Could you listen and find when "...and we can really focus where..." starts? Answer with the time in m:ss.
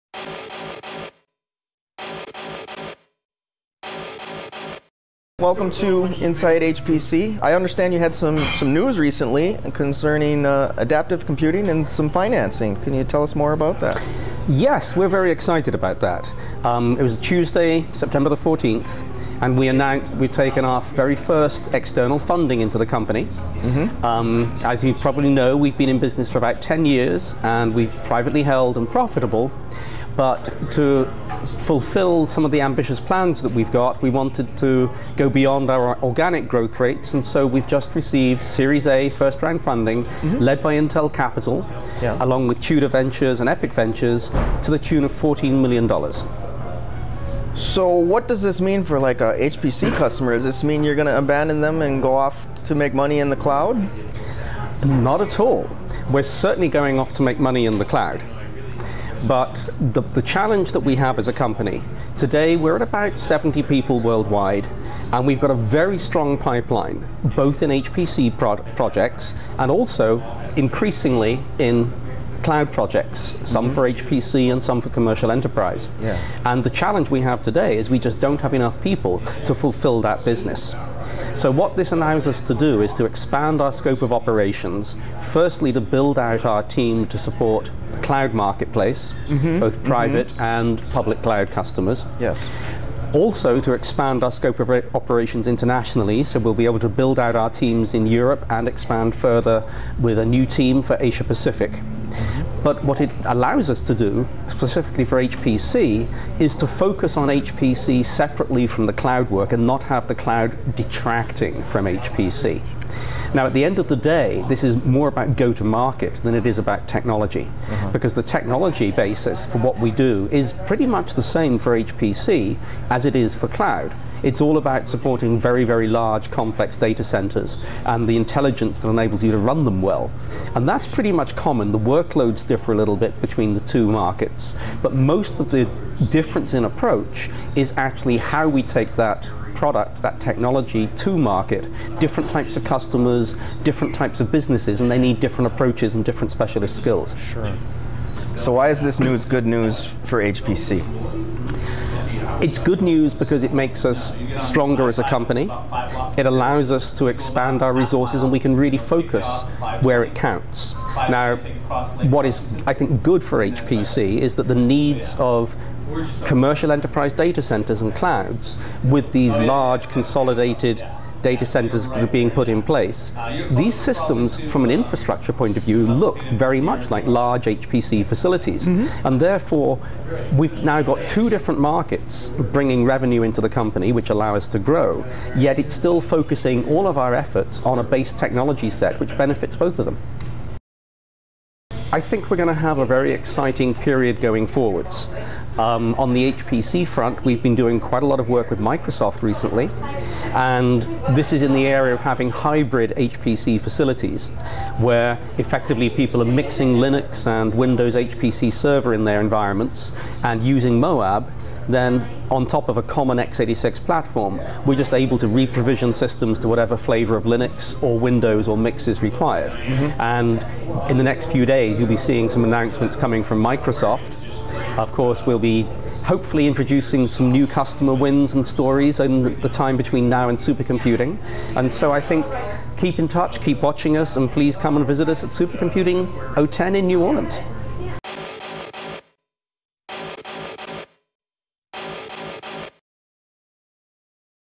2:38.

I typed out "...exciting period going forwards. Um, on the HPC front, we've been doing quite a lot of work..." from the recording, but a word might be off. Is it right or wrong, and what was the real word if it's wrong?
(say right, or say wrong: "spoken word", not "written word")
right.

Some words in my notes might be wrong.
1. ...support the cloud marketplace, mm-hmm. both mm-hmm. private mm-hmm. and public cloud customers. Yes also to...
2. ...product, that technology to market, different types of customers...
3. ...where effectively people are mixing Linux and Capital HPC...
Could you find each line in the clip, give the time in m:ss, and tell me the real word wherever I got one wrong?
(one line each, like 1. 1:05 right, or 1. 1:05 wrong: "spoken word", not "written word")
1. 1:27 right
2. 2:19 right
3. 3:24 wrong: "Windows", not "Capital".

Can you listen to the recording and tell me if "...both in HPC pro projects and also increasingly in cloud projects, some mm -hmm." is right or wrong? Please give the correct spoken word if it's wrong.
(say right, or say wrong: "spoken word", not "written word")
right.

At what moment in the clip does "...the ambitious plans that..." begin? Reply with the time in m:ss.
0:32.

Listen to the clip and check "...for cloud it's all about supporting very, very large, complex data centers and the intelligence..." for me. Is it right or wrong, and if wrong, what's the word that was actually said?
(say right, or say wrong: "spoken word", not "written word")
right.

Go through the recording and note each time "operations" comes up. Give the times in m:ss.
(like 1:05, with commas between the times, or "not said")
1:24, 1:34.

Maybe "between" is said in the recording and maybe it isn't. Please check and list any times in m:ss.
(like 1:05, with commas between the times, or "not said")
2:13, 3:49.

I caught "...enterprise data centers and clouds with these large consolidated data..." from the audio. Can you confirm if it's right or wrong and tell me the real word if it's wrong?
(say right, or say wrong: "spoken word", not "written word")
right.